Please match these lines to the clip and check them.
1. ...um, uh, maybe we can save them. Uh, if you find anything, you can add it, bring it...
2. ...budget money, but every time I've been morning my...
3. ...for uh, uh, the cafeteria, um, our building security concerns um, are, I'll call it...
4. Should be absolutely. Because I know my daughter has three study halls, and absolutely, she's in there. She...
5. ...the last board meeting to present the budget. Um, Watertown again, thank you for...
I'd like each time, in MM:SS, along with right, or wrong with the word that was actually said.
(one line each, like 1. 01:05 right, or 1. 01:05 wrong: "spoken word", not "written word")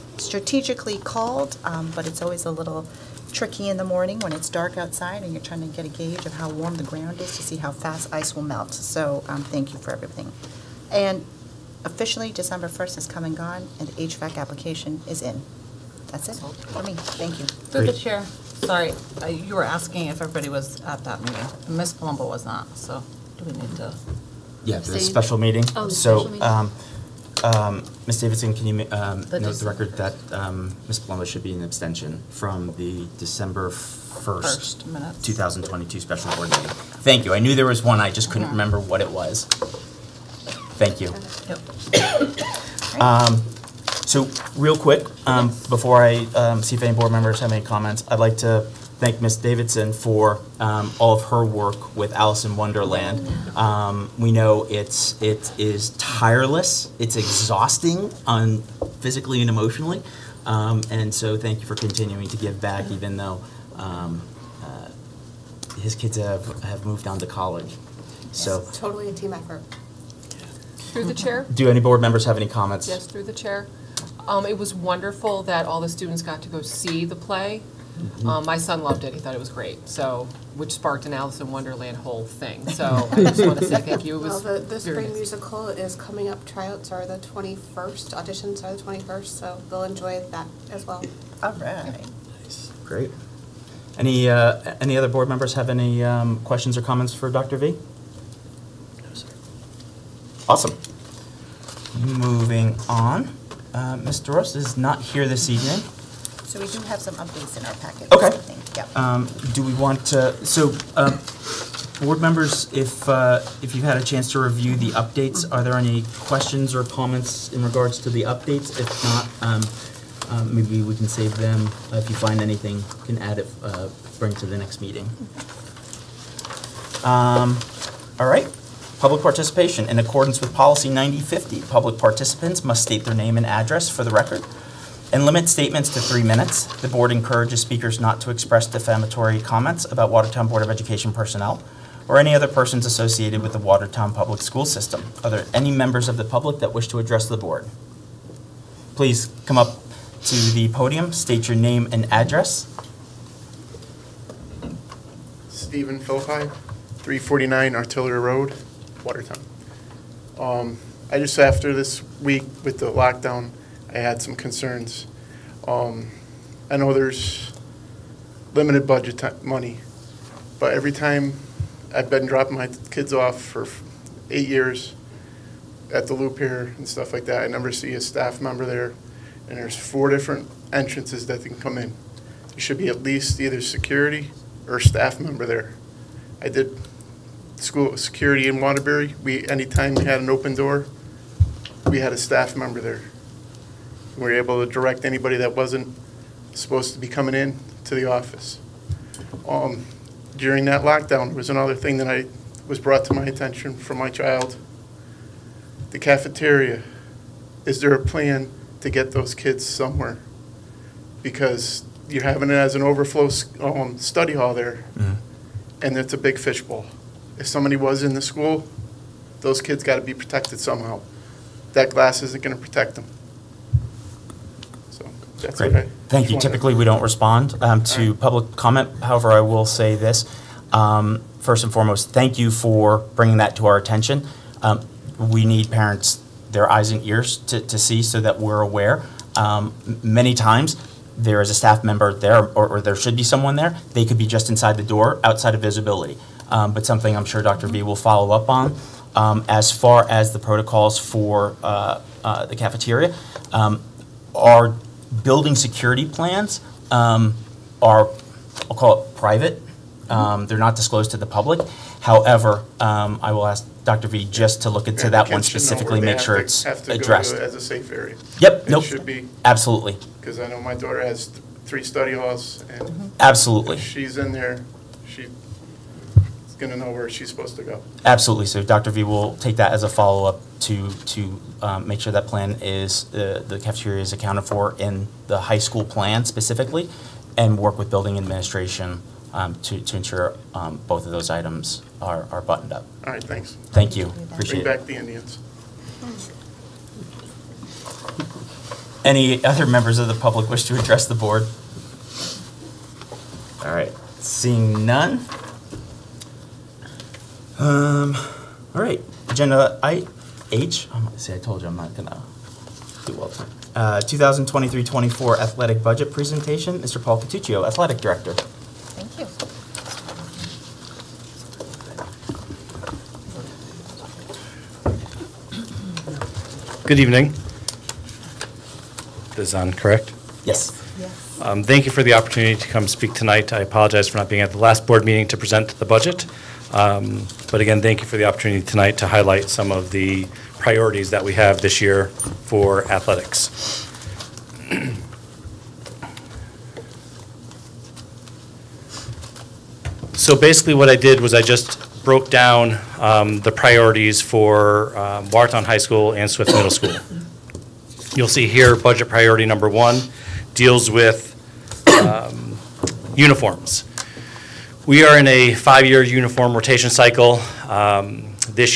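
1. 01:59 right
2. 02:48 wrong: "dropping", not "morning"
3. 04:10 wrong: "plans", not "concerns"
4. 04:28 right
5. 05:34 wrong: "But", not "Watertown".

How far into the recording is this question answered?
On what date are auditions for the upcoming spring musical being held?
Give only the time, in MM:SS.
01:28.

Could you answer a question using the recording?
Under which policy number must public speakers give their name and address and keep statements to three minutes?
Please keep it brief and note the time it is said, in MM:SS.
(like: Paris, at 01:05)
9050, at 02:10.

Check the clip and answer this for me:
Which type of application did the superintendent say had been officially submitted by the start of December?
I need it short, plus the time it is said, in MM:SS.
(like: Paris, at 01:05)
HVAC application, at 00:14.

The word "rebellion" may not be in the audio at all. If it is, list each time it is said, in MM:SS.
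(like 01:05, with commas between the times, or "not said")
not said.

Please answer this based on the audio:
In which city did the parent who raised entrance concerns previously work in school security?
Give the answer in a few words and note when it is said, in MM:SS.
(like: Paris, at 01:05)
Waterbury, at 03:08.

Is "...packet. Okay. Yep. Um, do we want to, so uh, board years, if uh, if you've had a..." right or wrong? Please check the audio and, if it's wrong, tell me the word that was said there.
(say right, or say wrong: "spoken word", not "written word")
wrong: "members", not "years".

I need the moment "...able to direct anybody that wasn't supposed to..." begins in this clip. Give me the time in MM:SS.
03:14.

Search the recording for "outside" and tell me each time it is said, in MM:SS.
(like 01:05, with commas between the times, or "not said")
00:04, 04:05.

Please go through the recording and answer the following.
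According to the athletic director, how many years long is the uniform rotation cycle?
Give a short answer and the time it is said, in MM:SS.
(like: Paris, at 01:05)
5, at 06:05.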